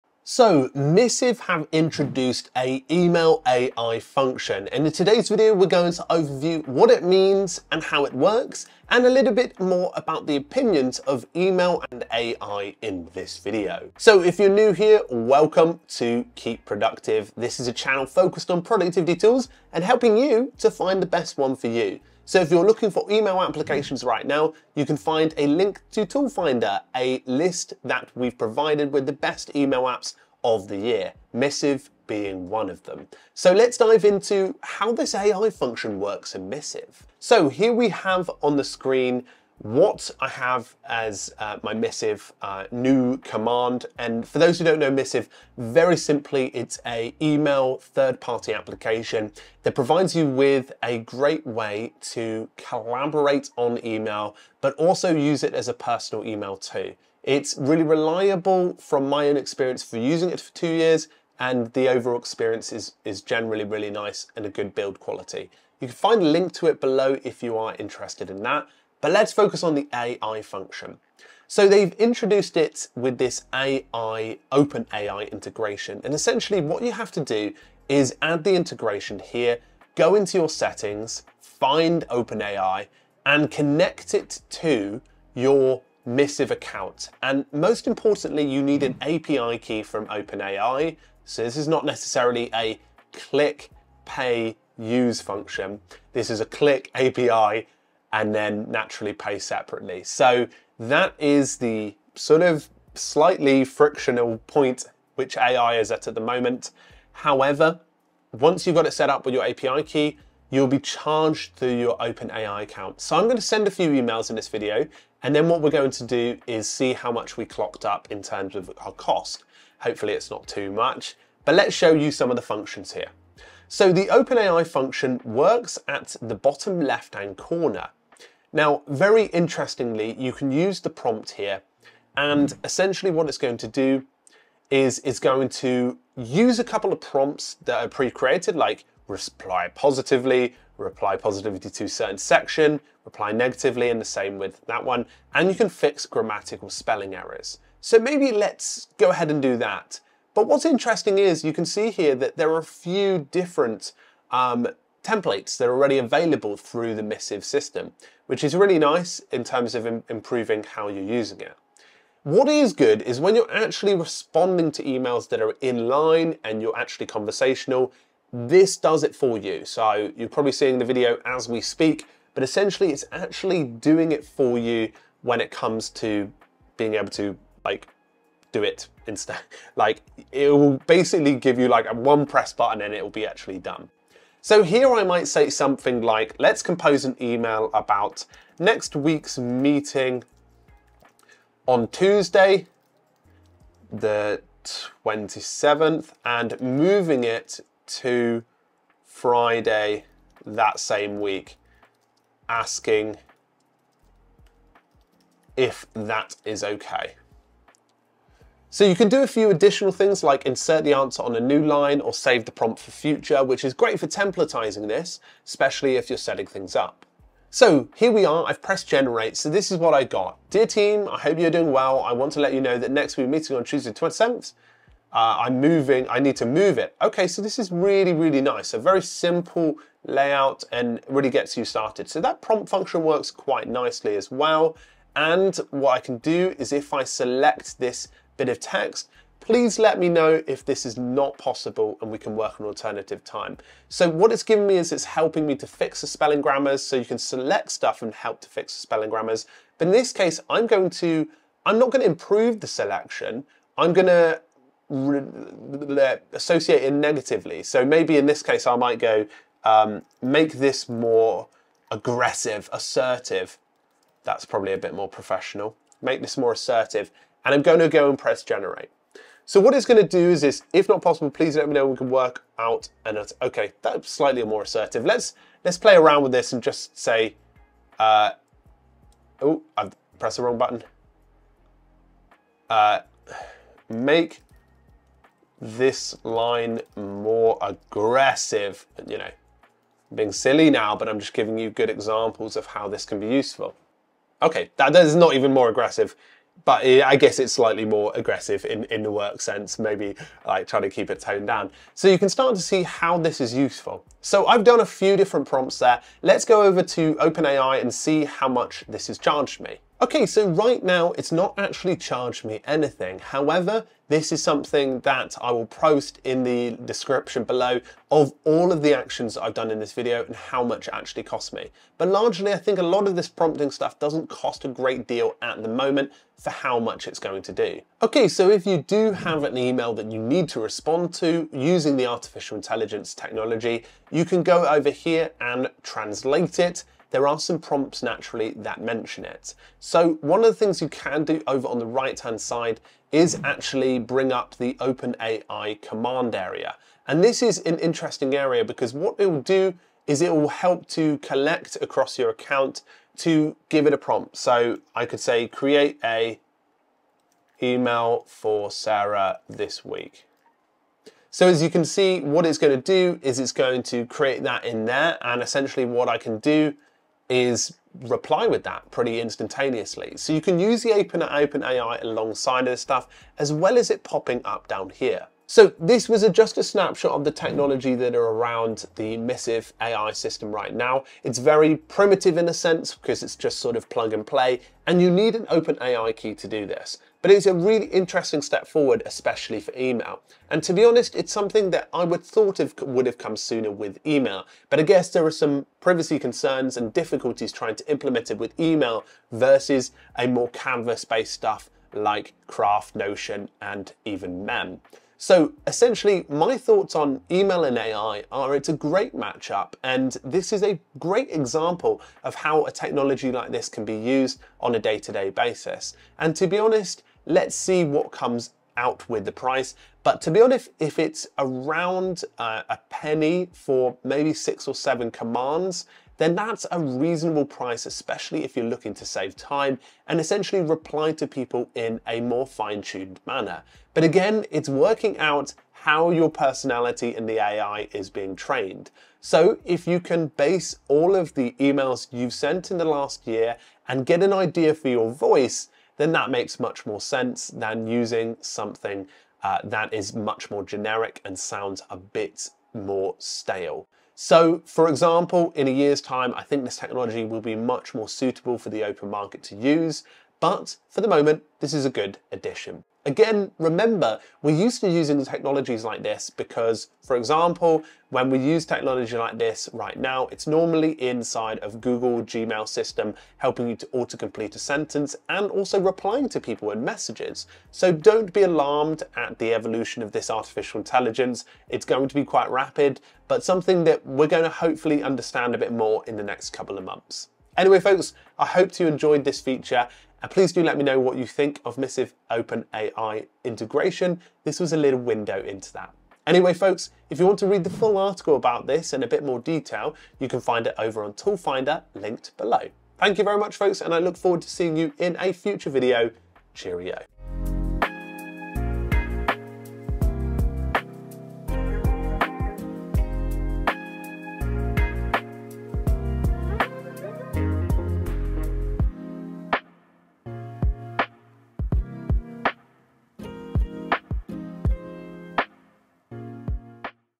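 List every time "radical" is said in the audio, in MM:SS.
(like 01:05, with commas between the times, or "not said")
not said.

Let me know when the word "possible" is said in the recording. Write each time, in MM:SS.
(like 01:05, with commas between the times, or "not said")
04:01, 04:31.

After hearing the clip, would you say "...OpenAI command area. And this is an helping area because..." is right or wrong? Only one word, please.
wrong.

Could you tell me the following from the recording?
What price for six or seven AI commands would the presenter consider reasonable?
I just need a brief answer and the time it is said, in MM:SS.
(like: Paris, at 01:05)
a penny, at 07:02.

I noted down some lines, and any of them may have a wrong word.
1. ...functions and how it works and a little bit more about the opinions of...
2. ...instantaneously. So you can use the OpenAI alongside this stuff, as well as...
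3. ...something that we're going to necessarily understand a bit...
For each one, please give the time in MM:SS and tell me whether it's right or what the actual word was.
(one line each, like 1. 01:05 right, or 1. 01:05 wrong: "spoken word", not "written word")
1. 00:07 wrong: "means", not "functions"
2. 06:09 right
3. 08:03 wrong: "hopefully", not "necessarily".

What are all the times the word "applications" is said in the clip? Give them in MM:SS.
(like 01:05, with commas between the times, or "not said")
00:23, 00:48.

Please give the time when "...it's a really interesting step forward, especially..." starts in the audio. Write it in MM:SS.
06:27.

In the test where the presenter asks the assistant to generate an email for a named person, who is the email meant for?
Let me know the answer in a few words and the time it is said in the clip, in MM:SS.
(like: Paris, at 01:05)
Sarah, at 05:58.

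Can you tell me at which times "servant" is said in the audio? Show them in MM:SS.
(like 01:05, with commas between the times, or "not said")
not said.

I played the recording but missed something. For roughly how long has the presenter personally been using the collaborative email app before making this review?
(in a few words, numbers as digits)
2 years.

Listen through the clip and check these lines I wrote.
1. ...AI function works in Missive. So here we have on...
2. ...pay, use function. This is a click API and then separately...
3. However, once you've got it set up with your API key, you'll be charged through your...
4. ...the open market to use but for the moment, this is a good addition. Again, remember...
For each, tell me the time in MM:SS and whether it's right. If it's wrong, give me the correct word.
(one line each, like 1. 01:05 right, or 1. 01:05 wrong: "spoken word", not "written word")
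1. 00:35 right
2. 01:34 wrong: "naturally", not "separately"
3. 01:47 right
4. 07:38 right.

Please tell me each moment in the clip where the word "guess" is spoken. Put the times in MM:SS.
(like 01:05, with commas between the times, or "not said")
04:57, 06:34.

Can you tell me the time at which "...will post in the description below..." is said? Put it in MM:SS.
05:15.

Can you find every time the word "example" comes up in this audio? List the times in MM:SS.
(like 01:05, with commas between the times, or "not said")
04:51, 06:51, 07:34, 07:47.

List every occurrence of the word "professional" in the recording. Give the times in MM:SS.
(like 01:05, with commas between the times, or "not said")
04:25.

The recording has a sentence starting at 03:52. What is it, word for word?
So that prompt function works quite nicely as well.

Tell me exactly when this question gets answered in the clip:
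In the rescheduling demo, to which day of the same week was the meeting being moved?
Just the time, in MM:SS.
03:19.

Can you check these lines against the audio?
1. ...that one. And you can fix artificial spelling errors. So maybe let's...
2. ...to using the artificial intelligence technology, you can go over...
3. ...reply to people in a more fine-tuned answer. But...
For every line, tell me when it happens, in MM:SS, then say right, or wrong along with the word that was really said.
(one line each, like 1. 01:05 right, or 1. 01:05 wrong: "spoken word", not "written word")
1. 02:24 wrong: "grammatical", not "artificial"
2. 05:31 right
3. 07:10 wrong: "manner", not "answer".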